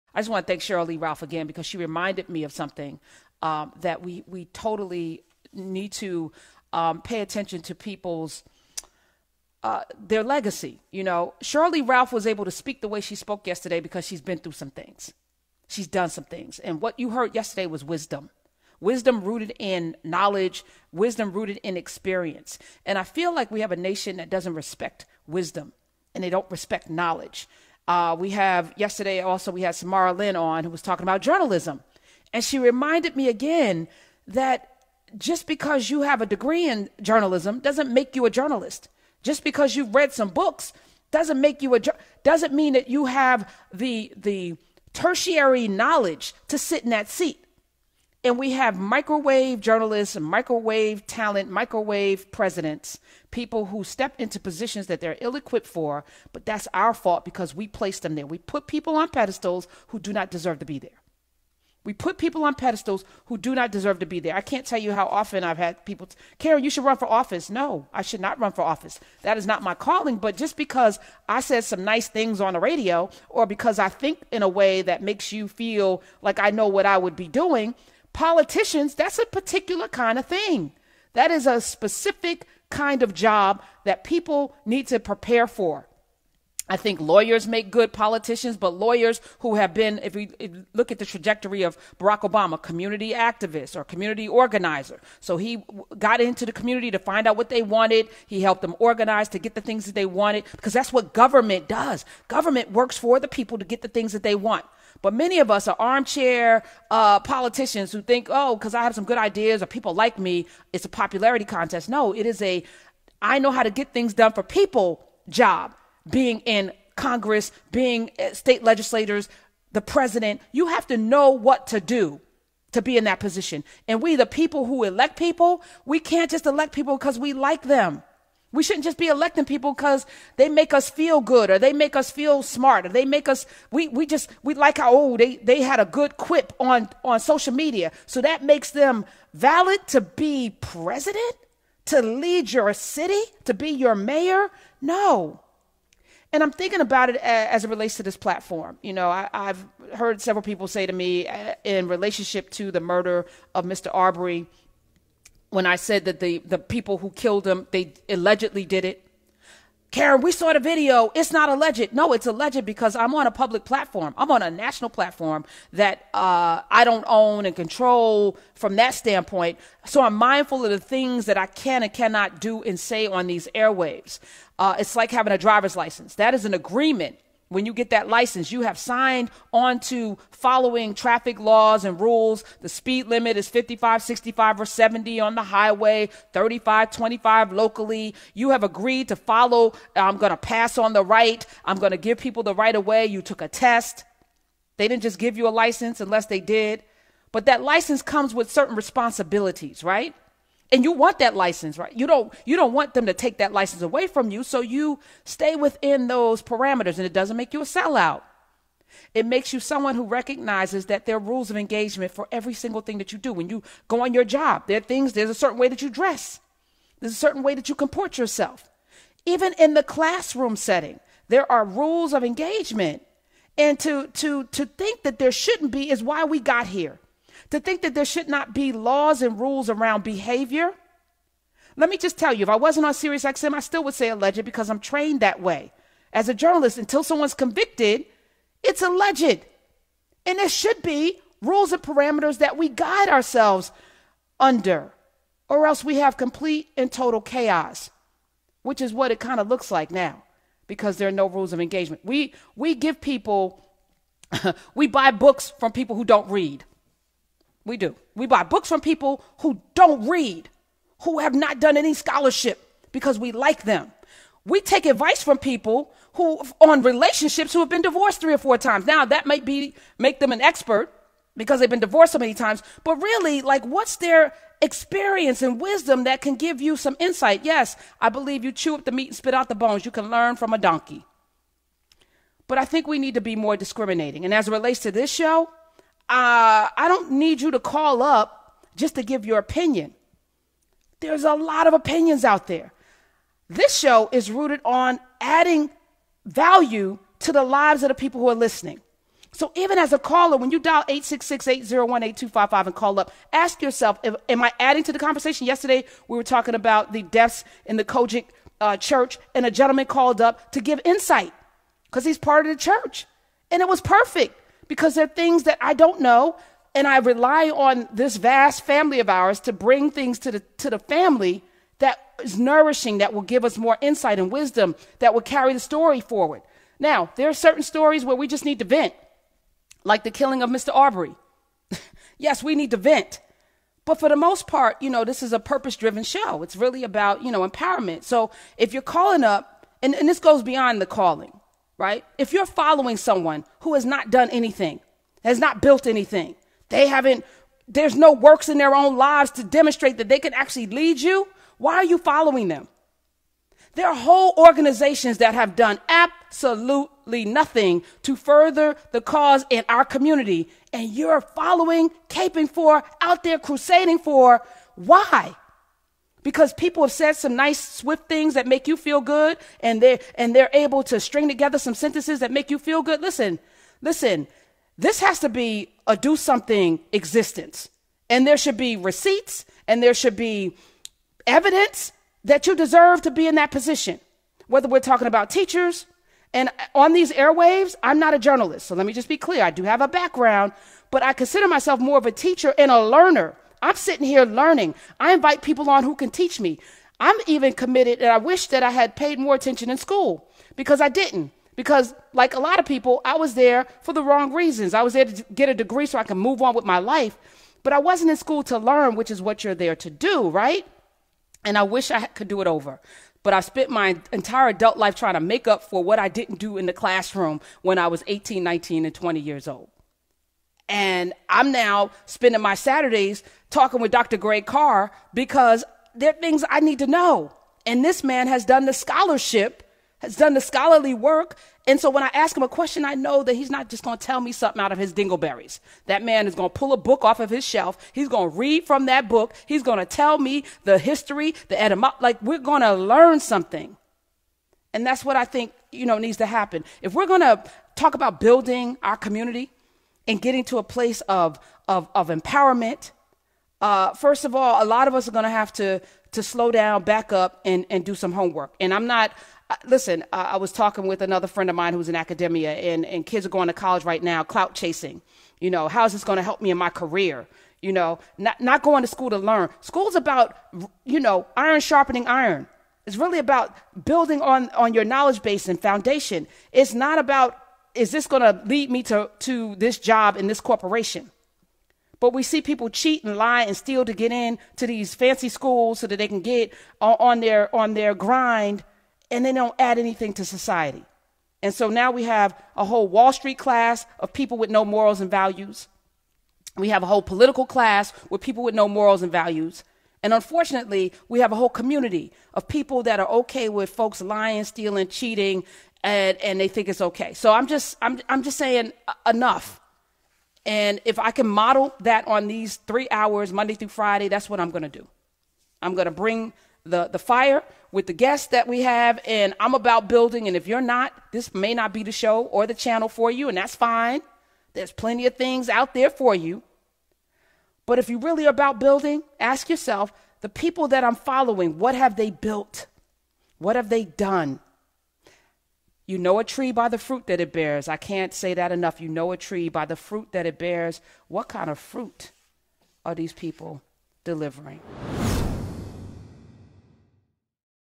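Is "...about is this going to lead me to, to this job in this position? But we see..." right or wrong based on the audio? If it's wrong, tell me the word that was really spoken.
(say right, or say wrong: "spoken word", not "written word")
wrong: "corporation", not "position".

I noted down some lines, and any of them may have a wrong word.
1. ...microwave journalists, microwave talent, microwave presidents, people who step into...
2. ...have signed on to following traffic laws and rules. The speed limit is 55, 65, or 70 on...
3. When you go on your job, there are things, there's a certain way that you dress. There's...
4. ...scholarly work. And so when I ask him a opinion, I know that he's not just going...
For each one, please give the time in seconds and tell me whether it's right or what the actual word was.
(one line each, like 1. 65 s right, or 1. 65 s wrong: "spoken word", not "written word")
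1. 48 s right
2. 178 s right
3. 213 s right
4. 430 s wrong: "question", not "opinion".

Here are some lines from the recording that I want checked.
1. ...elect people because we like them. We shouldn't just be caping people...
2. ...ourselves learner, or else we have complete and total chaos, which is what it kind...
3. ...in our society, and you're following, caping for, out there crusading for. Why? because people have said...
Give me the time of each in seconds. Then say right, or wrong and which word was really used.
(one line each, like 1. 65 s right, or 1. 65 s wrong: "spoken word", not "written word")
1. 126 s wrong: "electing", not "caping"
2. 243 s wrong: "under", not "learner"
3. 359 s wrong: "community", not "society".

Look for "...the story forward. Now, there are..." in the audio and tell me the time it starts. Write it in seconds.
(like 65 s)
325 s.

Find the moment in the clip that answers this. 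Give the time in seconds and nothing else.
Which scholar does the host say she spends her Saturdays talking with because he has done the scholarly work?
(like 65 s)
423 s.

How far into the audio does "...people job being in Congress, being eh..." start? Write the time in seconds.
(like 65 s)
114 s.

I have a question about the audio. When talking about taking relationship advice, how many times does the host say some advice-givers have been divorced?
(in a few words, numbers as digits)
3 or 4.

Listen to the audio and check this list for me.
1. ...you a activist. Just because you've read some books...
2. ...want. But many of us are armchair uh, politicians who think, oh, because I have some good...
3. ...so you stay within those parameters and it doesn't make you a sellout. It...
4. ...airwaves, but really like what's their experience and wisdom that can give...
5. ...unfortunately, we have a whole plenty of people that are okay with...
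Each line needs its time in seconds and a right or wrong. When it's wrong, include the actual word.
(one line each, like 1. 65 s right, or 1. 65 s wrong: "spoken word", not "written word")
1. 38 s wrong: "journalist", not "activist"
2. 104 s right
3. 204 s right
4. 272 s wrong: "times", not "airwaves"
5. 500 s wrong: "community", not "plenty".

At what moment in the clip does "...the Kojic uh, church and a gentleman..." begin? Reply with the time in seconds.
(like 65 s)
307 s.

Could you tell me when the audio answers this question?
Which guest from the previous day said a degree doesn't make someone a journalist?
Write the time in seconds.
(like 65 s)
29 s.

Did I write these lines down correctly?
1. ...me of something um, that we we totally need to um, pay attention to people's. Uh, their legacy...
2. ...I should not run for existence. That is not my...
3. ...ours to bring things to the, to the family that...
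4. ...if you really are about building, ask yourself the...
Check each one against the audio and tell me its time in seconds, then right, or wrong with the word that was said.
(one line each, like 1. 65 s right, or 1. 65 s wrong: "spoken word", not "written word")
1. 2 s right
2. 67 s wrong: "office", not "existence"
3. 319 s right
4. 527 s right.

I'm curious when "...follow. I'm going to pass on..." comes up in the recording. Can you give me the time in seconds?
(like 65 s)
189 s.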